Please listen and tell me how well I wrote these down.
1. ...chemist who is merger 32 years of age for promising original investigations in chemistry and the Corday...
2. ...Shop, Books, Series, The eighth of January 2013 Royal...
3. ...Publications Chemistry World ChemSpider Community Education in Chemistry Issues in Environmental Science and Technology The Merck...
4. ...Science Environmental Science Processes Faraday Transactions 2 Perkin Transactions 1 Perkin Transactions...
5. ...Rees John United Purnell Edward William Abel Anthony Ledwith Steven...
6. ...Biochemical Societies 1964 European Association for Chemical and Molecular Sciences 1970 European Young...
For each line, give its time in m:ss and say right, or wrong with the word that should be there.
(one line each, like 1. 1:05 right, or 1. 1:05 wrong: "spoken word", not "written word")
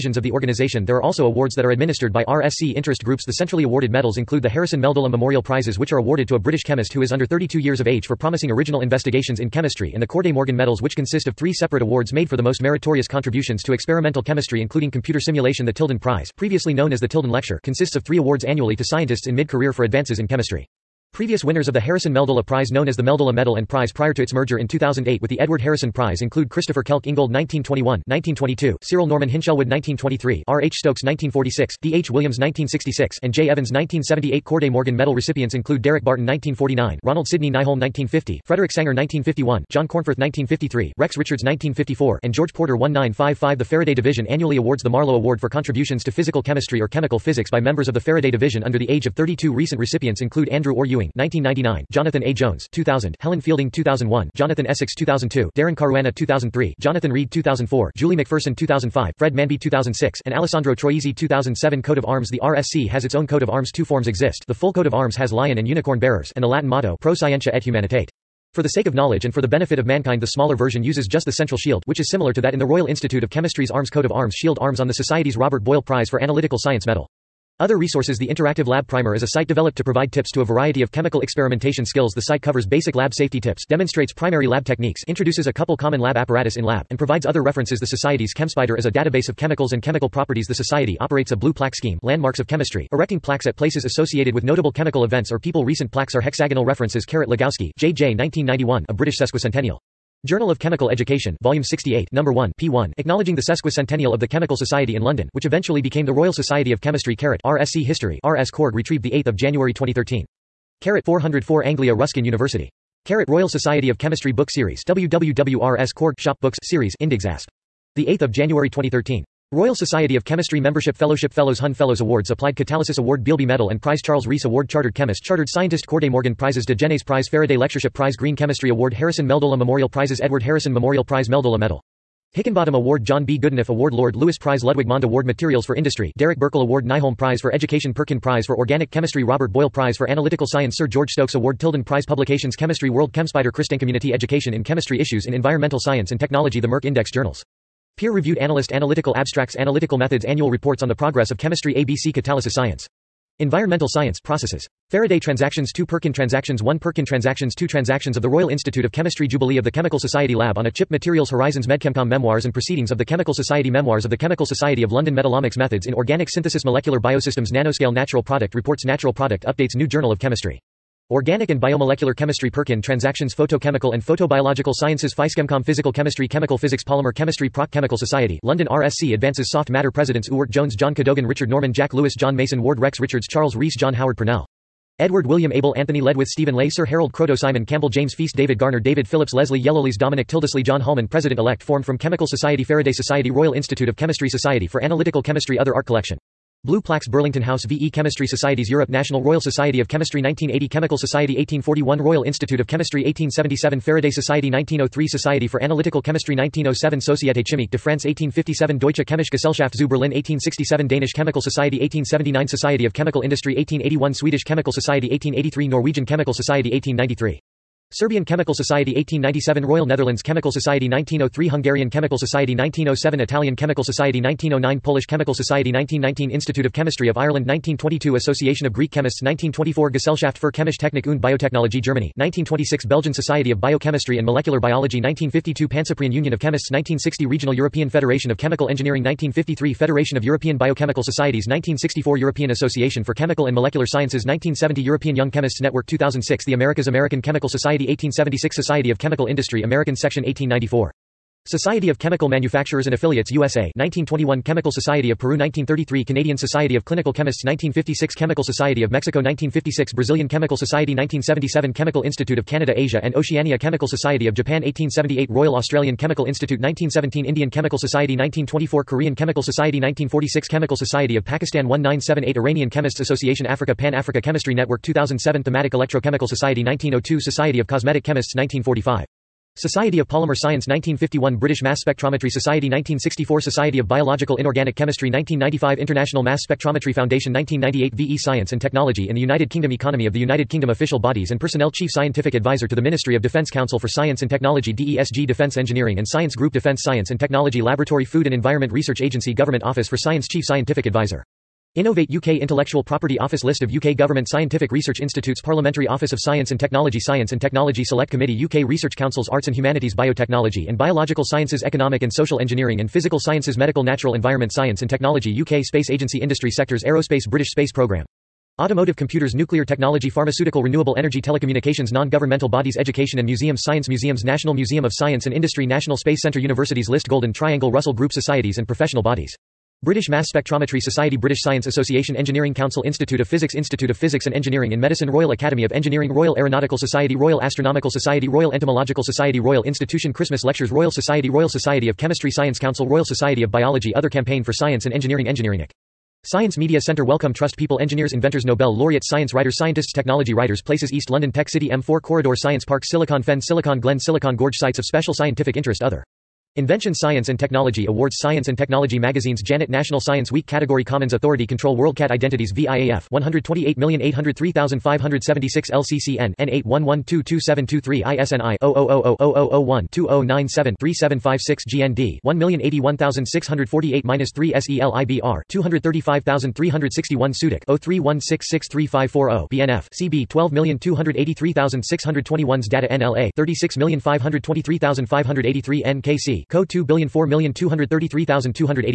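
1. 0:06 wrong: "under", not "merger"
2. 1:56 right
3. 2:22 right
4. 2:32 right
5. 3:03 wrong: "Howard", not "United"
6. 4:00 right.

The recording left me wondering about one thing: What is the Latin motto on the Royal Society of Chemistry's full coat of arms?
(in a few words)
Pro Scientia et Humanitate.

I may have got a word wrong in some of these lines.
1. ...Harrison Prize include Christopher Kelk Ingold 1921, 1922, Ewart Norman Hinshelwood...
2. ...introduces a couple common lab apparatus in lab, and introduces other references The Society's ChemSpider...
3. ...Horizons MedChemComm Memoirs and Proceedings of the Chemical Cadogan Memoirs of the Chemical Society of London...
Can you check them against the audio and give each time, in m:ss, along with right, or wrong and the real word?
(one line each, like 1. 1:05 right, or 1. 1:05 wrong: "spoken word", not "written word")
1. 0:25 wrong: "Cyril", not "Ewart"
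2. 1:25 wrong: "provides", not "introduces"
3. 2:41 wrong: "Society", not "Cadogan".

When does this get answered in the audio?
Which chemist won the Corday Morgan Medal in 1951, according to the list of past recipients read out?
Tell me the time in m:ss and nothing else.
0:38.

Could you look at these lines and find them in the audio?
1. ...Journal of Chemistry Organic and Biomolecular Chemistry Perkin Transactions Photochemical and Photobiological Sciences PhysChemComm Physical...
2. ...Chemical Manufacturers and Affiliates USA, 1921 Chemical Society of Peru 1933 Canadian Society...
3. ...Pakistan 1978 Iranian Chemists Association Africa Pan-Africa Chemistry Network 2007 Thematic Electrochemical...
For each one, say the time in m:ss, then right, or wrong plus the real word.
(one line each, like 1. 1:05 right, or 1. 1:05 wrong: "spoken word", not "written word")
1. 2:49 right
2. 4:11 right
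3. 4:31 right.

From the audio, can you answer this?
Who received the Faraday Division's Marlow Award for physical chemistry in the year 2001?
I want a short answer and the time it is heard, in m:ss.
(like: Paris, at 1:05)
Helen Fielding, at 0:53.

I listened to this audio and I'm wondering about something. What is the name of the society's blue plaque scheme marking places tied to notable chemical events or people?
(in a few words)
Landmarks of Chemistry.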